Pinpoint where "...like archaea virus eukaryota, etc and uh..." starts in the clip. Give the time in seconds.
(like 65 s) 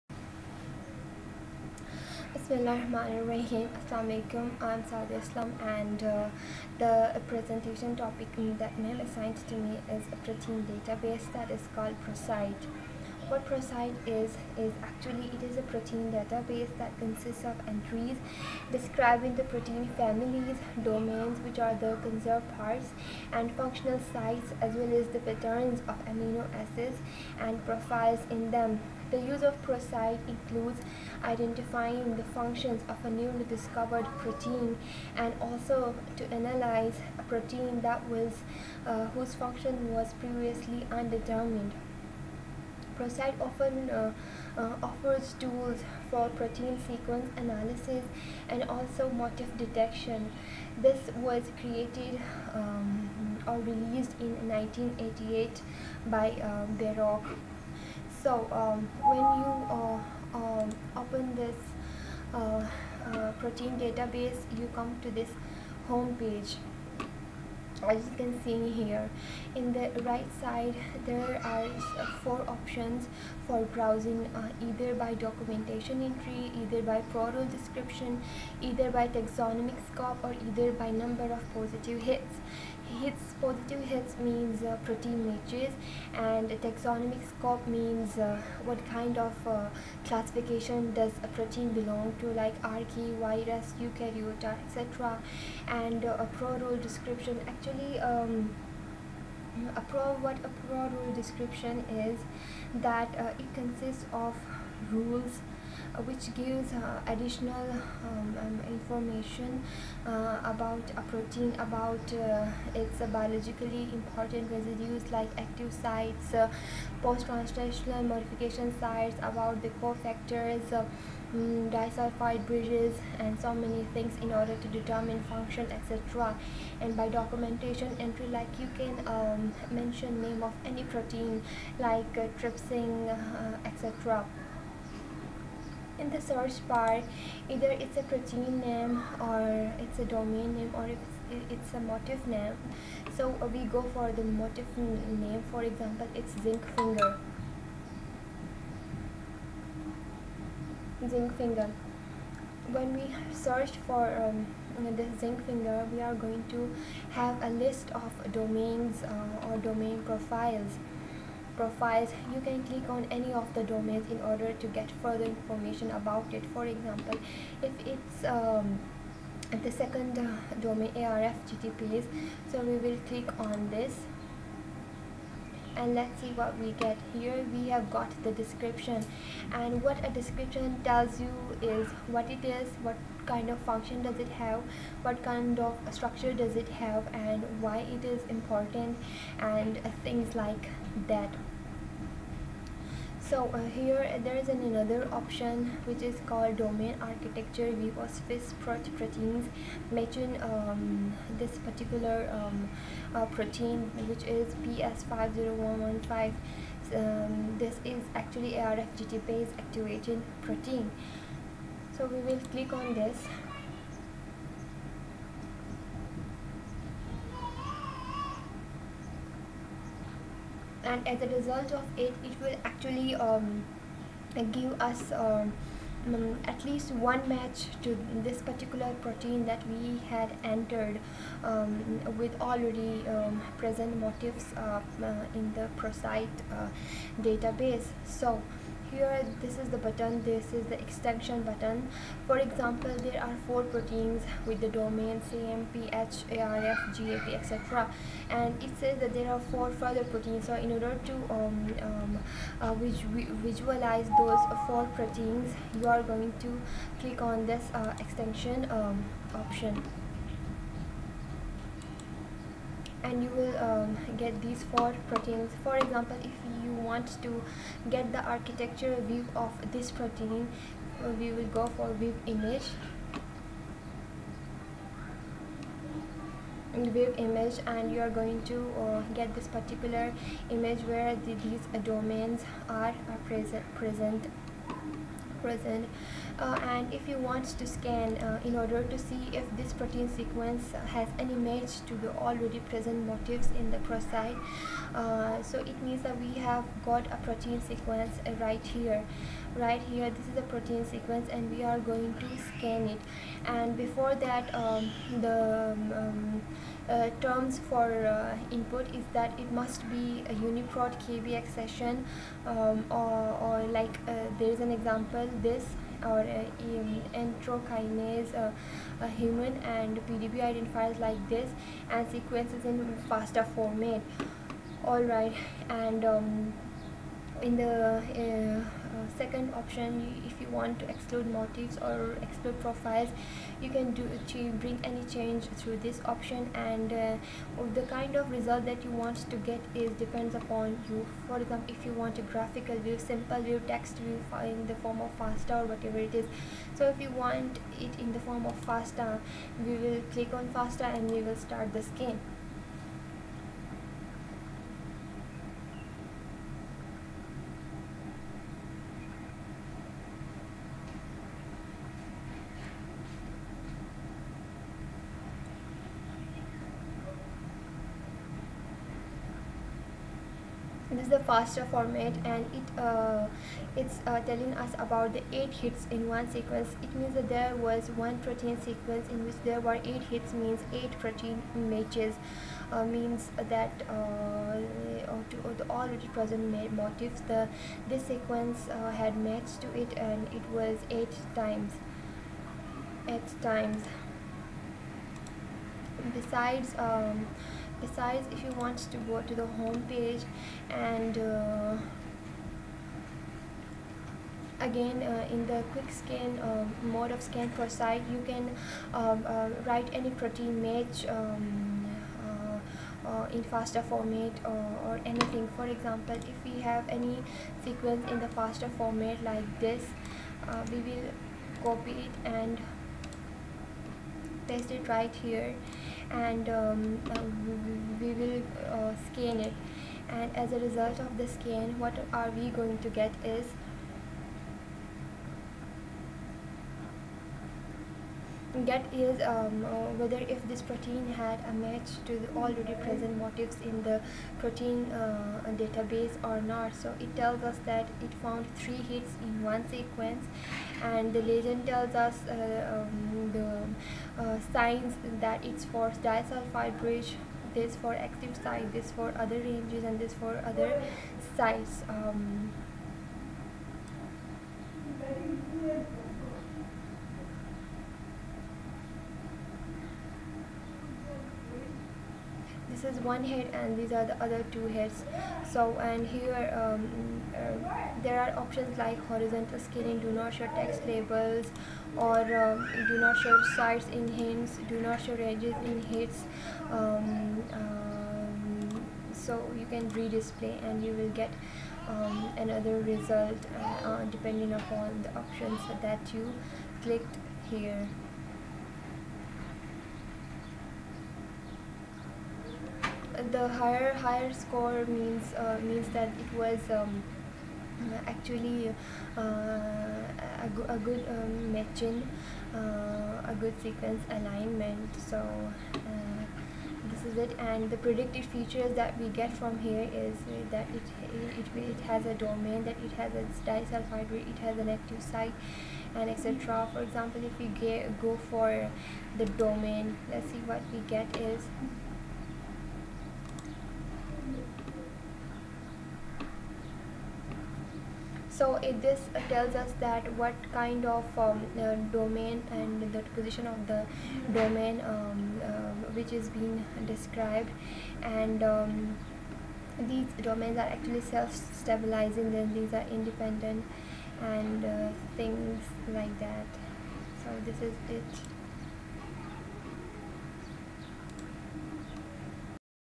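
92 s.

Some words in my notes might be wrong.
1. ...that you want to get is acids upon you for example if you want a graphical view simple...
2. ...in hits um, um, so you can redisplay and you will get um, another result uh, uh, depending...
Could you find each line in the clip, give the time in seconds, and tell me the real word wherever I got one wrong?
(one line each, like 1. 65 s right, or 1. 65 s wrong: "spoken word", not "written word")
1. 338 s wrong: "depends", not "acids"
2. 485 s right.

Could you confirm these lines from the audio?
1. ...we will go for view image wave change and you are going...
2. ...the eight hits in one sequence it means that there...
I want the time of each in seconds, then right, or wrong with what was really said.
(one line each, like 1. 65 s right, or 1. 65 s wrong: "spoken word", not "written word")
1. 271 s wrong: "image", not "change"
2. 375 s right.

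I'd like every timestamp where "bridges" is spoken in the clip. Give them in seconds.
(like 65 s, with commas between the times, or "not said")
122 s, 456 s.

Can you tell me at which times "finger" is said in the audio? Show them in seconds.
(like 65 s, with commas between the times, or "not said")
146 s, 151 s, 155 s.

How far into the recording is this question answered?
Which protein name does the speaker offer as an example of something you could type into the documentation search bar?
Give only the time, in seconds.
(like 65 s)
132 s.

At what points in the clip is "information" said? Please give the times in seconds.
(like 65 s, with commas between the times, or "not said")
108 s, 165 s.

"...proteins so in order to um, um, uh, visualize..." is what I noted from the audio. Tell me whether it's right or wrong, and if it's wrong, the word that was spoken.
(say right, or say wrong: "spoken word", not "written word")
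right.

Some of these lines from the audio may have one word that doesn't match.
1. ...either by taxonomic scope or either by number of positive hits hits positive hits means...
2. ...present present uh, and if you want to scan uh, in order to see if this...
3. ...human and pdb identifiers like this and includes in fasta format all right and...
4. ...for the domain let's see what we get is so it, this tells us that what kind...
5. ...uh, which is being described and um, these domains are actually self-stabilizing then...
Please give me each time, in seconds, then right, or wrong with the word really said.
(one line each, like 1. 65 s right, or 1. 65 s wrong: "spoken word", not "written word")
1. 78 s right
2. 283 s right
3. 319 s wrong: "sequences", not "includes"
4. 528 s right
5. 545 s right.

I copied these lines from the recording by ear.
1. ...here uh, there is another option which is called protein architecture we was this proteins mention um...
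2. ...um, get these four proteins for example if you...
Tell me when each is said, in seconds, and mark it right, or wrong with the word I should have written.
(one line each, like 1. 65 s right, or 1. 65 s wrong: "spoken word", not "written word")
1. 193 s wrong: "domain", not "protein"
2. 263 s right.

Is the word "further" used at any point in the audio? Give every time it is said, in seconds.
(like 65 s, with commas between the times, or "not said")
165 s, 249 s.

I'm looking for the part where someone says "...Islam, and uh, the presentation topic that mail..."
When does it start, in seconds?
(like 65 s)
5 s.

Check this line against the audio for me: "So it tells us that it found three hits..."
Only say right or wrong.
right.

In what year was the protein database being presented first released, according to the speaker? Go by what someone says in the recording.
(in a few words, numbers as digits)
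1988.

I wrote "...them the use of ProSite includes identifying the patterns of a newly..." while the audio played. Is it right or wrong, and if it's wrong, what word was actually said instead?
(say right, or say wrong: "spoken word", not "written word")
wrong: "functions", not "patterns".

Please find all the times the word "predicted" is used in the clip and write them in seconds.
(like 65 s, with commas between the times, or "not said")
517 s.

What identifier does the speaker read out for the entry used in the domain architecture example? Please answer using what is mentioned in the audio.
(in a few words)
PS50115.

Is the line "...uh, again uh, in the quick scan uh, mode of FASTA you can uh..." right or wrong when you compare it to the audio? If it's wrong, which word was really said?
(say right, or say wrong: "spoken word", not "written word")
wrong: "ScanProsite", not "FASTA".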